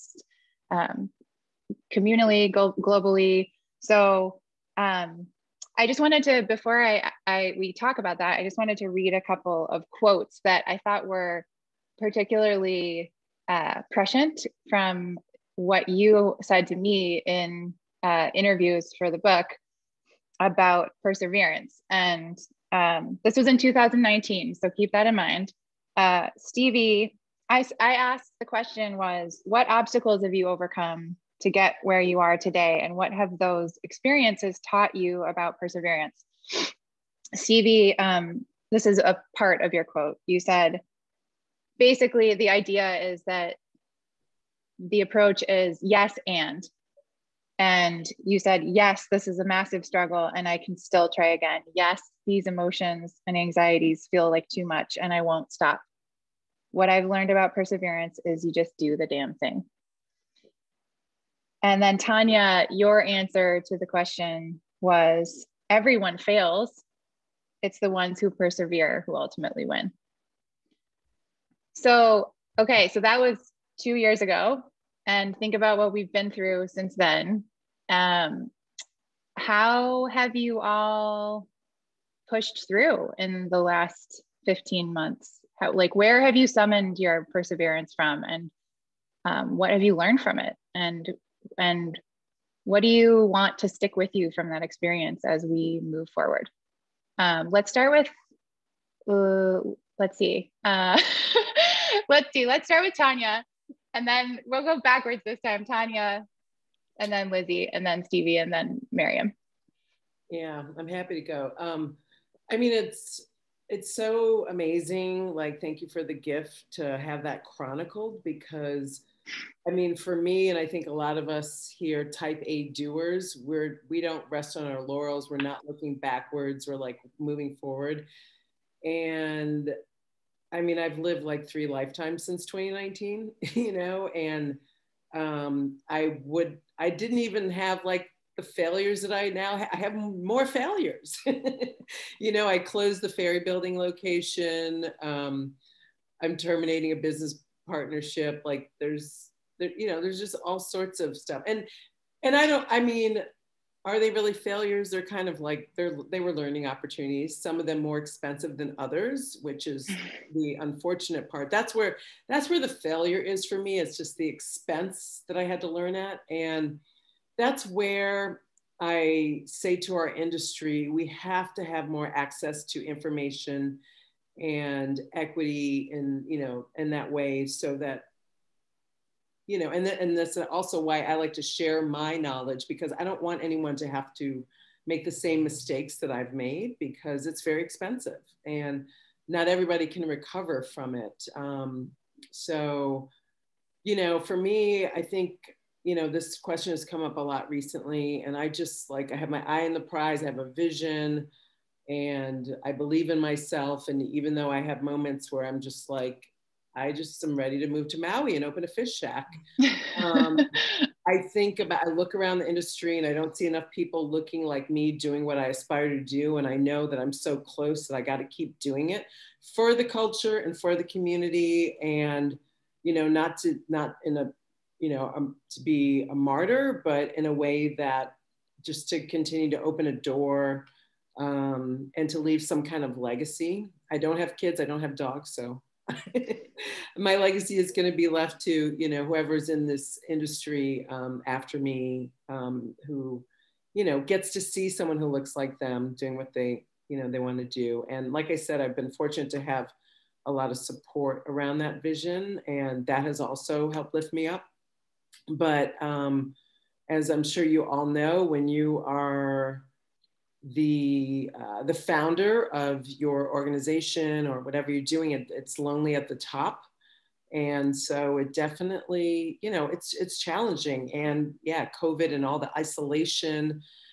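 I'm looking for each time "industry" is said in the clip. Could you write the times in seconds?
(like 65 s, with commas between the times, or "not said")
170 s, 212 s, 240 s.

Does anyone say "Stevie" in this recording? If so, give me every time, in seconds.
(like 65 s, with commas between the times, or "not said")
26 s, 37 s, 108 s.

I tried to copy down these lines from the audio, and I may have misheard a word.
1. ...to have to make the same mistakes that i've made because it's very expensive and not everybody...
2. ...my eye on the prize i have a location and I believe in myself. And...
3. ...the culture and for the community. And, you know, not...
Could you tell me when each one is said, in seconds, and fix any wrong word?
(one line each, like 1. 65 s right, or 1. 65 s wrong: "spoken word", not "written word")
1. 183 s right
2. 199 s wrong: "vision", not "location"
3. 219 s right.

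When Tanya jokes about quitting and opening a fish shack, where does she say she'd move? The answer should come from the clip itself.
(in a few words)
Maui.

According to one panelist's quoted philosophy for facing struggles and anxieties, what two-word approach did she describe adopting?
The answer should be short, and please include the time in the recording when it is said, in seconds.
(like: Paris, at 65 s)
yes and, at 45 s.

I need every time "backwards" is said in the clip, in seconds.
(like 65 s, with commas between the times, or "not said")
104 s, 125 s.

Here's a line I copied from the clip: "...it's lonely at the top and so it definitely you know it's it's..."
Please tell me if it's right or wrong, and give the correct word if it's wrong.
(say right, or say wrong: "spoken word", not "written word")
right.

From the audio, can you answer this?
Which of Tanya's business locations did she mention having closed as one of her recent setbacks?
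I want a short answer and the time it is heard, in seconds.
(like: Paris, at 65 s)
Ferry Building, at 143 s.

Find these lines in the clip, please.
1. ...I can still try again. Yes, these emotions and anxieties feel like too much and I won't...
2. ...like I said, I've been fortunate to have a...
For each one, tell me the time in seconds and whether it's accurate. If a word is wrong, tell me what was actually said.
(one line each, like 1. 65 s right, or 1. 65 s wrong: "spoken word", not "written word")
1. 50 s right
2. 248 s right.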